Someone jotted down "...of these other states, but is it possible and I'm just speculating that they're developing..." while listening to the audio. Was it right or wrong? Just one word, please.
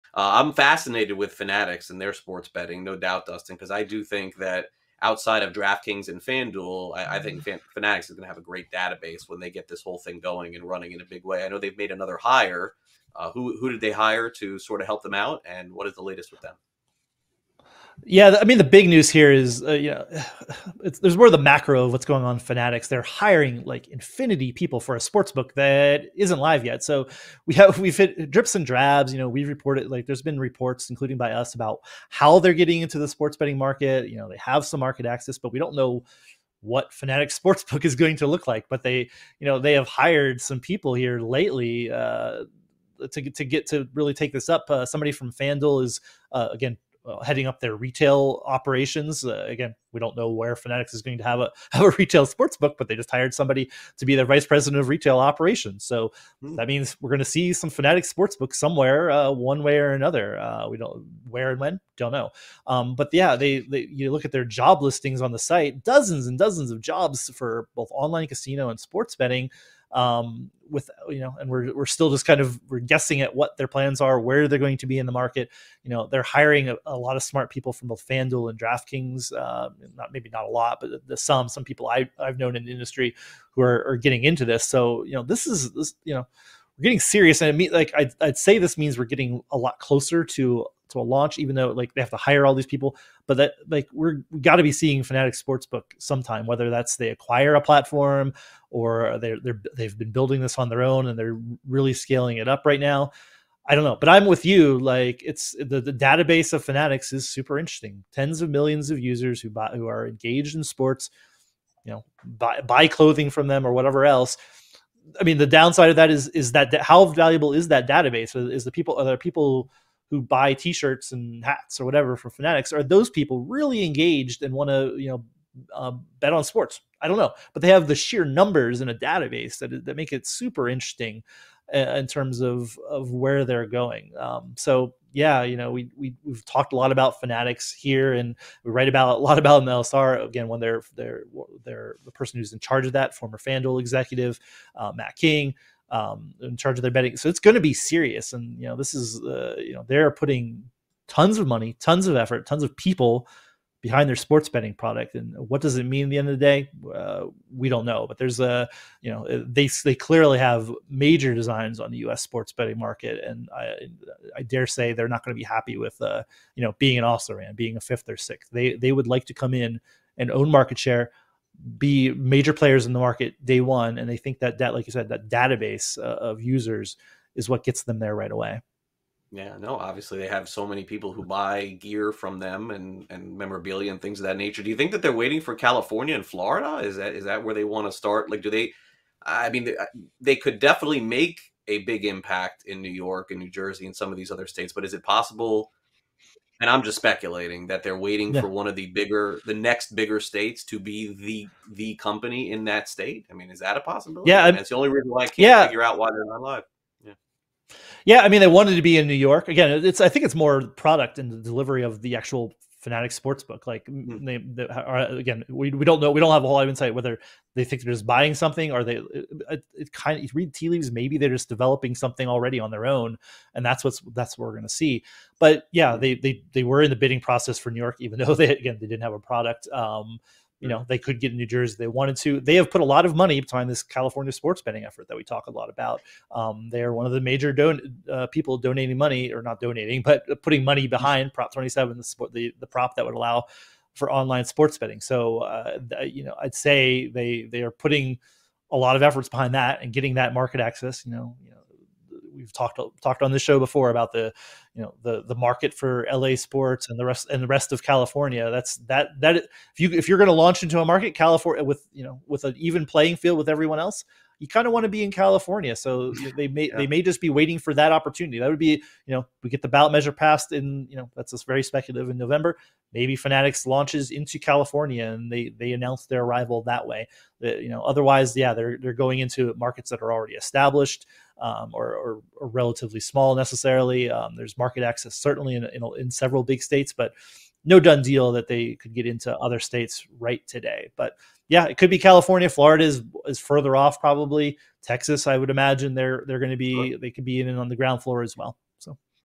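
wrong.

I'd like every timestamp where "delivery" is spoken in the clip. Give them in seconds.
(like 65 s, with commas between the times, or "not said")
211 s.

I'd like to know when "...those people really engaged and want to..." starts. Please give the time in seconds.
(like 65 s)
122 s.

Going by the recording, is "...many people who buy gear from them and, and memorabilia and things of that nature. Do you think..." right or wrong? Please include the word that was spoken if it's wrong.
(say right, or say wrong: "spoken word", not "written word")
right.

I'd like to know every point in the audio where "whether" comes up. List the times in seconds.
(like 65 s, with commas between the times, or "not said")
96 s, 216 s.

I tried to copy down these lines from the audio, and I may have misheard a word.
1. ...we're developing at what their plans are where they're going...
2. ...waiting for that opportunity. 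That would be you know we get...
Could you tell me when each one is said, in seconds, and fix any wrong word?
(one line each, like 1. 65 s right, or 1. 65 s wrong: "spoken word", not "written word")
1. 72 s wrong: "guessing", not "developing"
2. 267 s right.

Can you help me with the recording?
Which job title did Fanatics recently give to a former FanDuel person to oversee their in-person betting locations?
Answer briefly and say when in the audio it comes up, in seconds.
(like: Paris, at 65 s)
vice president of retail operations, at 54 s.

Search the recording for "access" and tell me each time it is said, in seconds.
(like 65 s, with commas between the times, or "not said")
35 s, 250 s, 284 s.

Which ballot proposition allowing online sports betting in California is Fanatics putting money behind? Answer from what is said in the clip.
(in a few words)
Prop 27.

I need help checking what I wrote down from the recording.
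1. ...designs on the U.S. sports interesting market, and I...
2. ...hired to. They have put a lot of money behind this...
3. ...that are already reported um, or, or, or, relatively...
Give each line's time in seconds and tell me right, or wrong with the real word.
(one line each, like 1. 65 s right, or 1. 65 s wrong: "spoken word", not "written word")
1. 161 s wrong: "betting", not "interesting"
2. 231 s wrong: "wanted", not "hired"
3. 279 s wrong: "established", not "reported".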